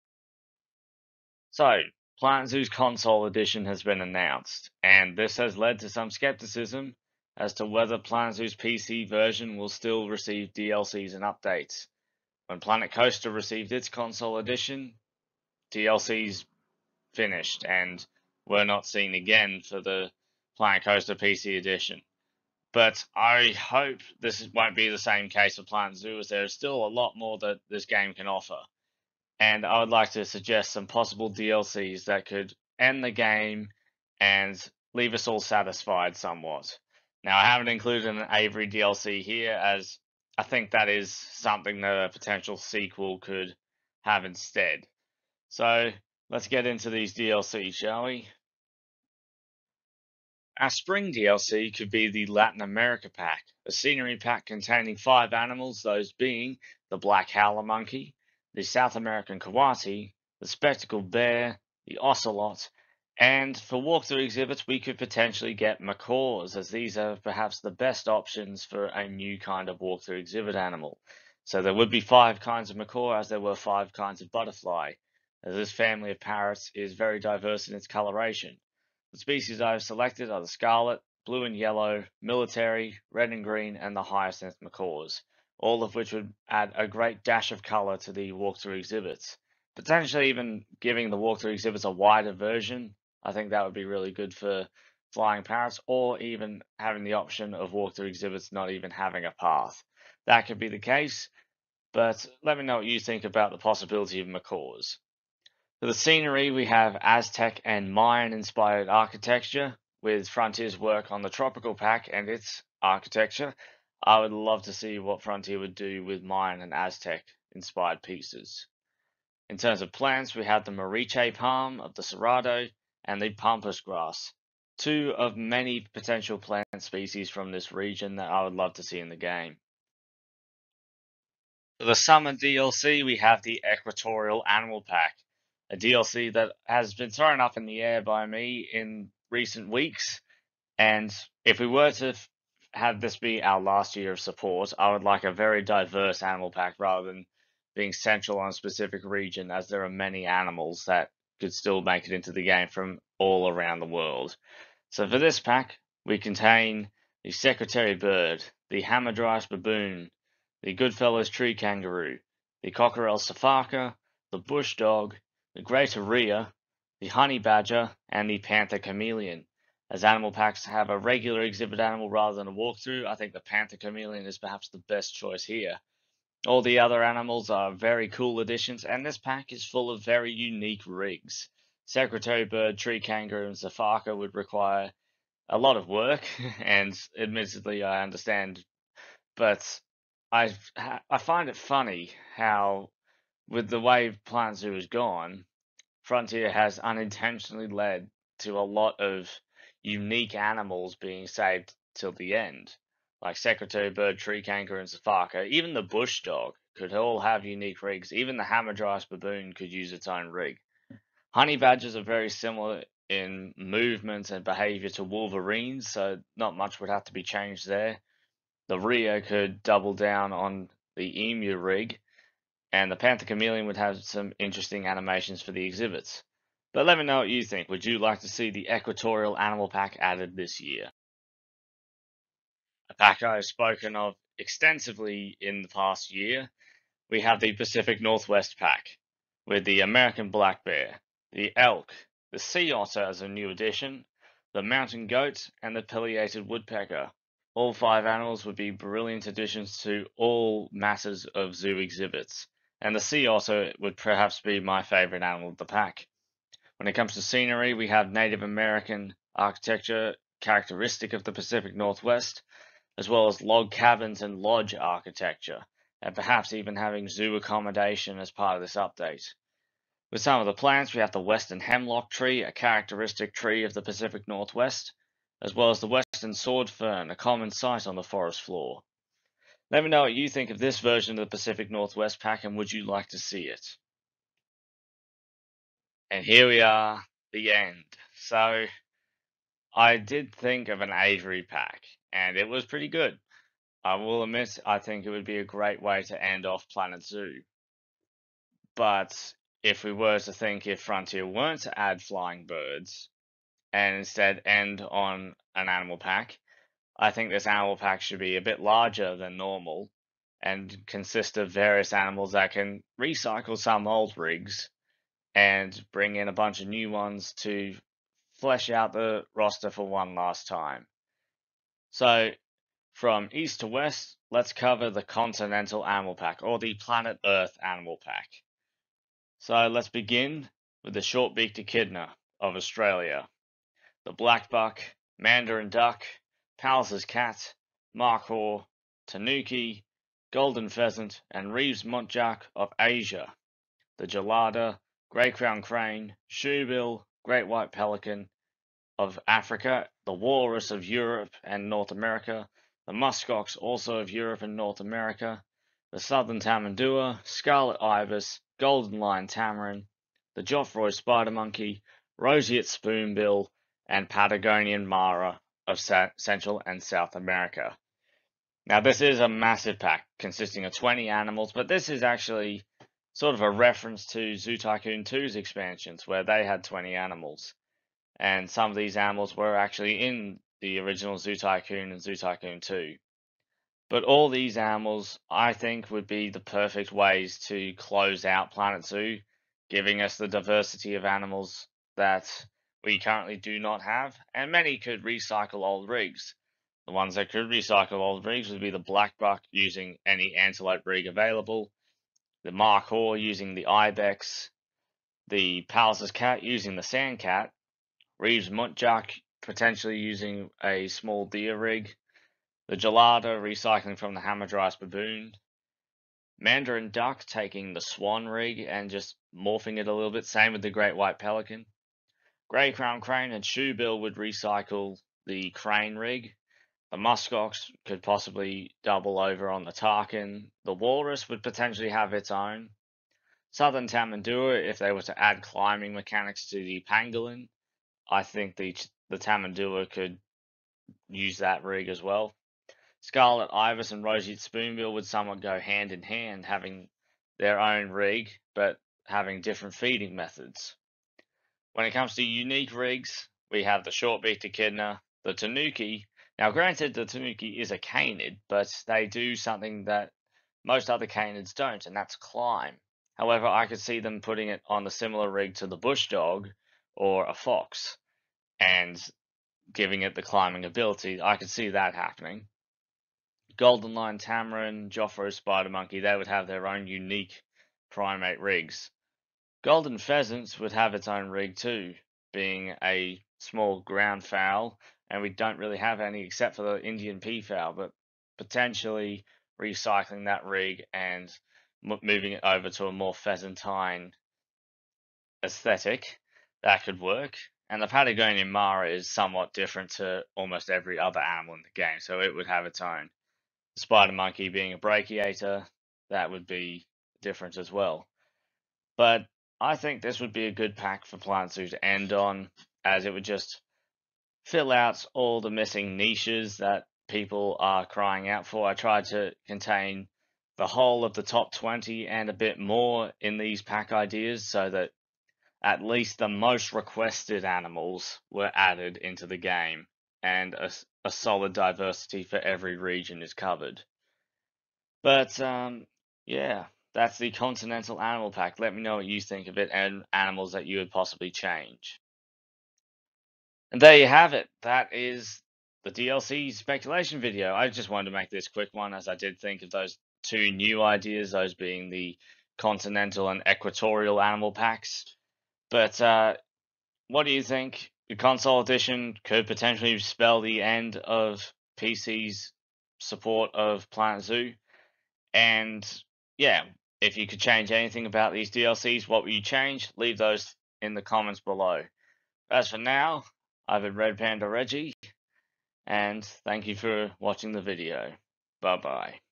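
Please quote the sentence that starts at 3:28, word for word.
Even the hamadryas baboon could use its own rig.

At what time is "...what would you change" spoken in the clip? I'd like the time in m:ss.
9:29.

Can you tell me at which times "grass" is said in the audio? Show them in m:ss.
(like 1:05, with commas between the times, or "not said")
2:03.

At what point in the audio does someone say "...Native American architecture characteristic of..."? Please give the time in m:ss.
4:18.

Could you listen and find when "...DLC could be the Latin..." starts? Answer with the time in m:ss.
0:51.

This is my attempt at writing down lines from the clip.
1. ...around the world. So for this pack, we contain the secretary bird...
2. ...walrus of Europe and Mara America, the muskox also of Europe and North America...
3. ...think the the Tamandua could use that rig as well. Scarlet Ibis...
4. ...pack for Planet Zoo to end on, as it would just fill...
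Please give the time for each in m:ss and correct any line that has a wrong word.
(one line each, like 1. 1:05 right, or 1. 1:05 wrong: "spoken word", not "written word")
1. 2:33 right
2. 5:50 wrong: "North", not "Mara"
3. 7:18 right
4. 8:30 right.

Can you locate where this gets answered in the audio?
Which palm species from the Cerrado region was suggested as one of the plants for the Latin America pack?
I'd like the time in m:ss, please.
2:00.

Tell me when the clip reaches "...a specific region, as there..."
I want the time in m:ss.
2:28.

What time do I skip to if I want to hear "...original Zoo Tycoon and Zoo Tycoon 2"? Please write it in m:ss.
6:20.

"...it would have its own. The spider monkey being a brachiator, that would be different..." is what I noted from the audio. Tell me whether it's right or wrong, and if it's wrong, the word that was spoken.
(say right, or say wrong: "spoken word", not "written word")
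right.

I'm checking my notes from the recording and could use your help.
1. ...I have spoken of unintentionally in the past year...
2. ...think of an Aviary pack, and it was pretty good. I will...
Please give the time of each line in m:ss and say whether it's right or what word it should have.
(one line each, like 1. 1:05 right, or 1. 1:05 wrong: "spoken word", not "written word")
1. 3:53 wrong: "extensively", not "unintentionally"
2. 4:50 right.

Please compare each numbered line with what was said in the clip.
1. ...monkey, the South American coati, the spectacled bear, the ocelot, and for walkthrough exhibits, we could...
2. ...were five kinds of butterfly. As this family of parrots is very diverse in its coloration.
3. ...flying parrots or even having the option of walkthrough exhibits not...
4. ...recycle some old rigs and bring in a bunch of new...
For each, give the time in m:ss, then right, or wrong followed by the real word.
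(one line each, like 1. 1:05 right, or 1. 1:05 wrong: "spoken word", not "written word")
1. 0:57 right
2. 1:13 right
3. 1:35 right
4. 5:12 right.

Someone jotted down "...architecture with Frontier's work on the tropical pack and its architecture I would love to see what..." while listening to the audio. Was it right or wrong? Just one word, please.
right.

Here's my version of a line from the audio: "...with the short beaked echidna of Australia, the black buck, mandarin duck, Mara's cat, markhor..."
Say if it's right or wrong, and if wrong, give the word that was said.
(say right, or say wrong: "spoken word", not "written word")
wrong: "Pallas", not "Mara".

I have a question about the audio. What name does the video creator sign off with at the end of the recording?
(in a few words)
Red Panda Reggie.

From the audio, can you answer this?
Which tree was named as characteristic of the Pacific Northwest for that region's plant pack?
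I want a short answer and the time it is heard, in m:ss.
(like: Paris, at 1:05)
Western hemlock, at 4:31.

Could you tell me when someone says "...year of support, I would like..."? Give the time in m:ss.
2:23.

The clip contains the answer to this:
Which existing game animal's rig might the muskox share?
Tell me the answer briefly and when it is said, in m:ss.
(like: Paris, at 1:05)
Takin, at 7:09.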